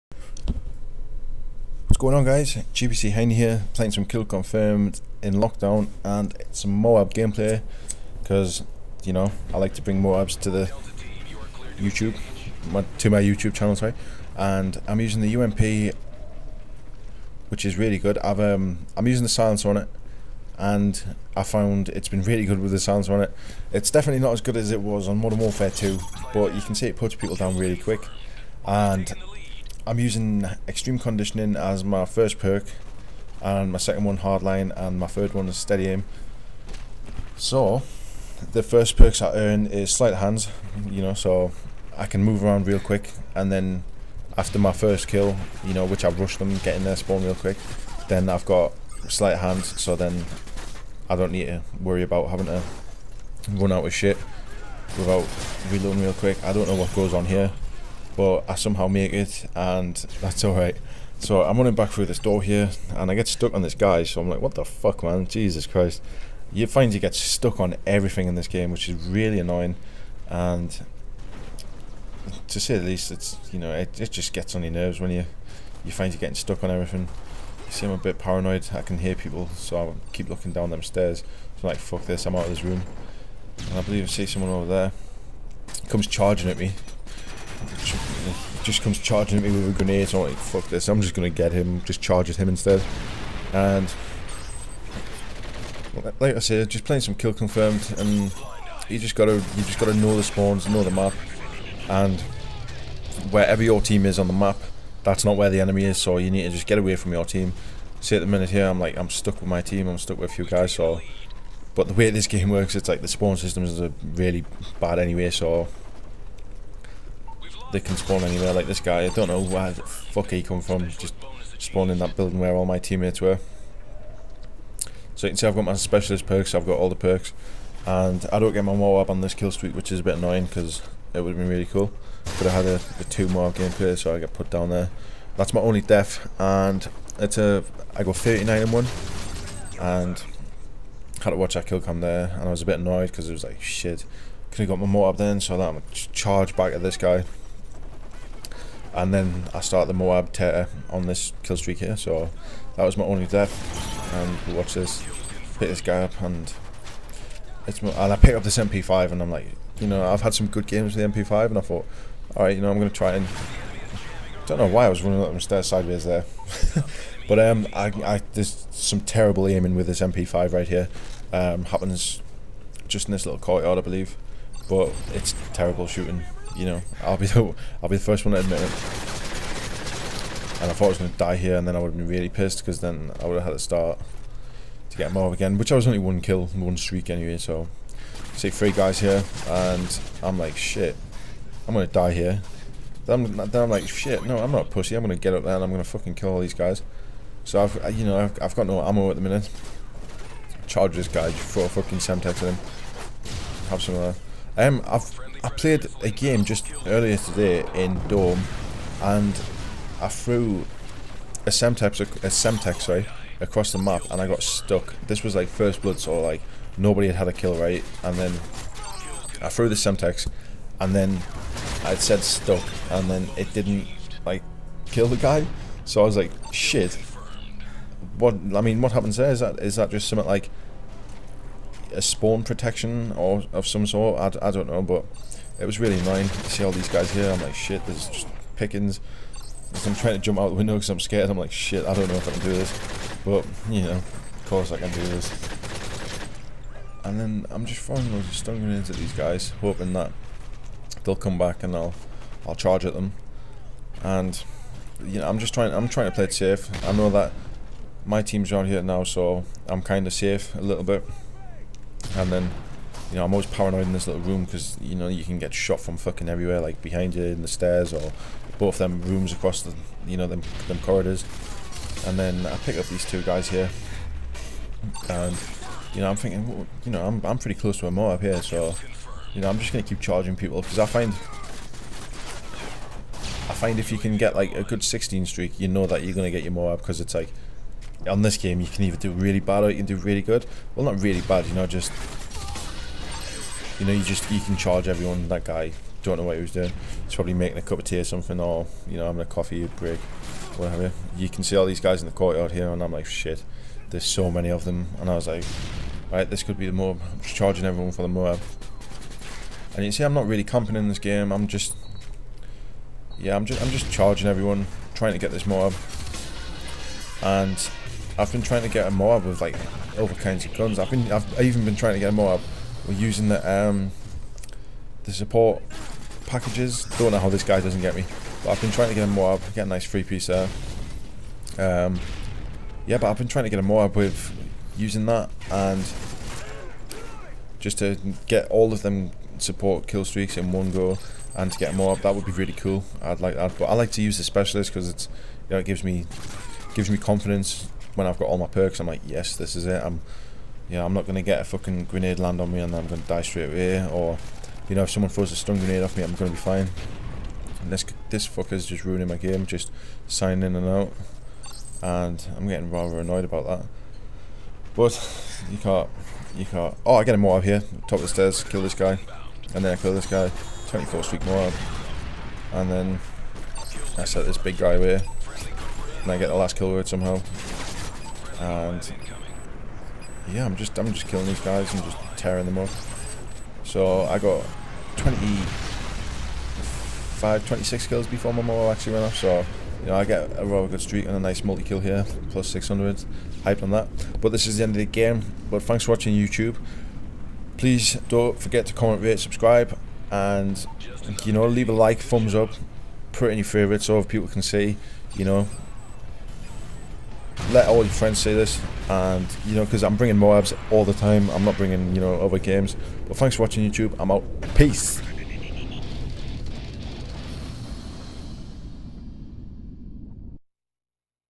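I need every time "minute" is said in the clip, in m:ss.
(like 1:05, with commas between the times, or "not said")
1:48, 3:19.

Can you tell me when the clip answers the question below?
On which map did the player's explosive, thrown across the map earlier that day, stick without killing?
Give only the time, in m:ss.
3:28.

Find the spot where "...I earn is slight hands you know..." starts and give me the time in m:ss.
0:39.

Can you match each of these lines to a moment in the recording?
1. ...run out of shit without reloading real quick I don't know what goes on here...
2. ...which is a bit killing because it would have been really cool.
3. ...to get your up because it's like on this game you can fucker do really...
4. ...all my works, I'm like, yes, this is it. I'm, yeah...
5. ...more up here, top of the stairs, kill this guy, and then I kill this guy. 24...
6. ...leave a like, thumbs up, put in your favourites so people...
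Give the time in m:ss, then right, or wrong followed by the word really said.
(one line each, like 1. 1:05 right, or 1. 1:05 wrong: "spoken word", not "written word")
1. 0:53 right
2. 2:09 wrong: "annoying", not "killing"
3. 4:46 wrong: "either", not "fucker"
4. 5:48 wrong: "perks", not "works"
5. 6:07 right
6. 6:41 right.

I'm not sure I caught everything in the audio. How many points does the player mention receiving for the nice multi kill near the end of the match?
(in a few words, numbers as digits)
600.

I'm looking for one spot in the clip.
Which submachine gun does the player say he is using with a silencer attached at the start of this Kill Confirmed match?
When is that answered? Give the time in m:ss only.
0:15.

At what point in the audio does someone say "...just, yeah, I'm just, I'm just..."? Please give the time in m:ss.
5:11.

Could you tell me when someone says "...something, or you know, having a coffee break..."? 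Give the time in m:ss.
4:58.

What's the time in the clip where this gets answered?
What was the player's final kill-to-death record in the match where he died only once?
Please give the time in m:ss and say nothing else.
2:18.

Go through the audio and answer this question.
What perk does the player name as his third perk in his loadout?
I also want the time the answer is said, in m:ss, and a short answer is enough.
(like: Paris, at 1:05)
steady aim, at 0:35.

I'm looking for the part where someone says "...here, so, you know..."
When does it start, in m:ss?
4:38.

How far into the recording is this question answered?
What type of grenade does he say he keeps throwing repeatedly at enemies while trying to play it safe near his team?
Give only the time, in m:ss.
4:08.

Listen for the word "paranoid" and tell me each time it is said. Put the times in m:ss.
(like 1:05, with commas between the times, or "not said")
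1:18, 4:23.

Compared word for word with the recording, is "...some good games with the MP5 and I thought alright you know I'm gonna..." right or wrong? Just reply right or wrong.
right.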